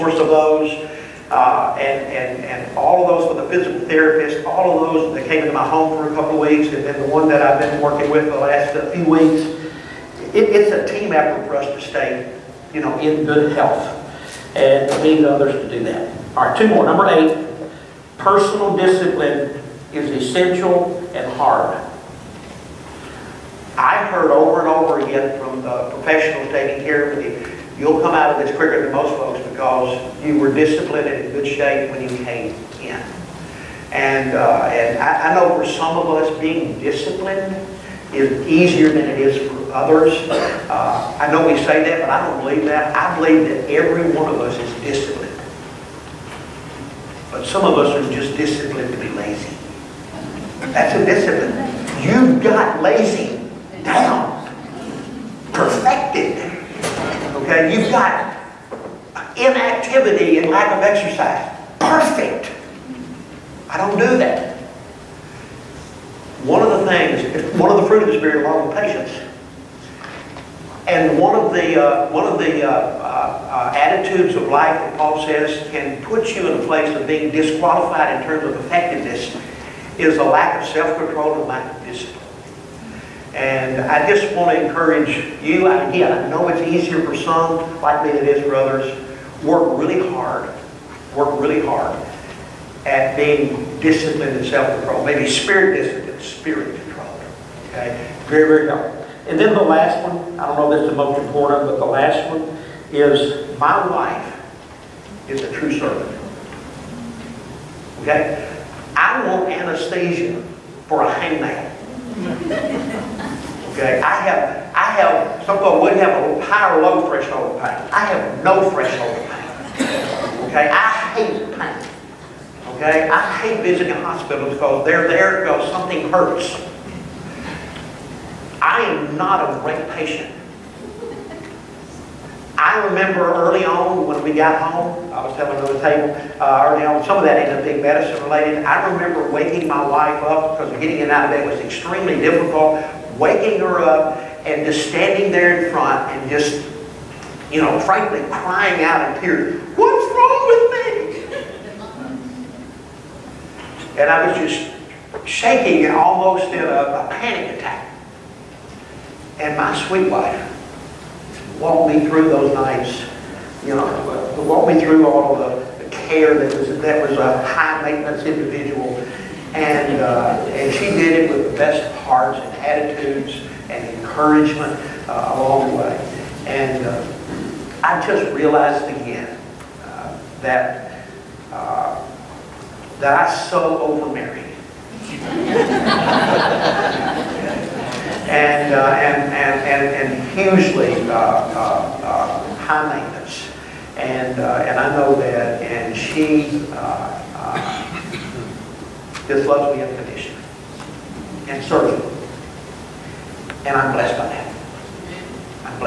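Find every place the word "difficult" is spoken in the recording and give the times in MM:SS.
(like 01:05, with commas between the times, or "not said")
02:22.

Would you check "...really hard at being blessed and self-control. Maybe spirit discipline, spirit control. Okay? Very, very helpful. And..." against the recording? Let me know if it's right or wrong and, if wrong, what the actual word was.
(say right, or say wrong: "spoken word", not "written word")
wrong: "disciplined", not "blessed".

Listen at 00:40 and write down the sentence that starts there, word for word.
Uh, I know we say that, but I don't believe that.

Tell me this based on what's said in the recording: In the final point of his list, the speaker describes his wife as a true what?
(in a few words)
Servant.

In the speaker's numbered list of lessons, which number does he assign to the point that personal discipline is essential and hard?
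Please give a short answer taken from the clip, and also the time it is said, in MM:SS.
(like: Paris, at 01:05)
8, at 00:17.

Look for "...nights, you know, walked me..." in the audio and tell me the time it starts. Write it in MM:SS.
02:42.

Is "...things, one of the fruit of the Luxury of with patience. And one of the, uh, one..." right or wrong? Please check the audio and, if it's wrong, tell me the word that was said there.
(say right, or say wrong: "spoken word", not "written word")
wrong: "Spirit", not "Luxury".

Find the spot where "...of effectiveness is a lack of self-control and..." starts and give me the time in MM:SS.
01:18.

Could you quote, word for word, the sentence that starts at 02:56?
And uh, I just realized again uh, that uh, that I so overmarried.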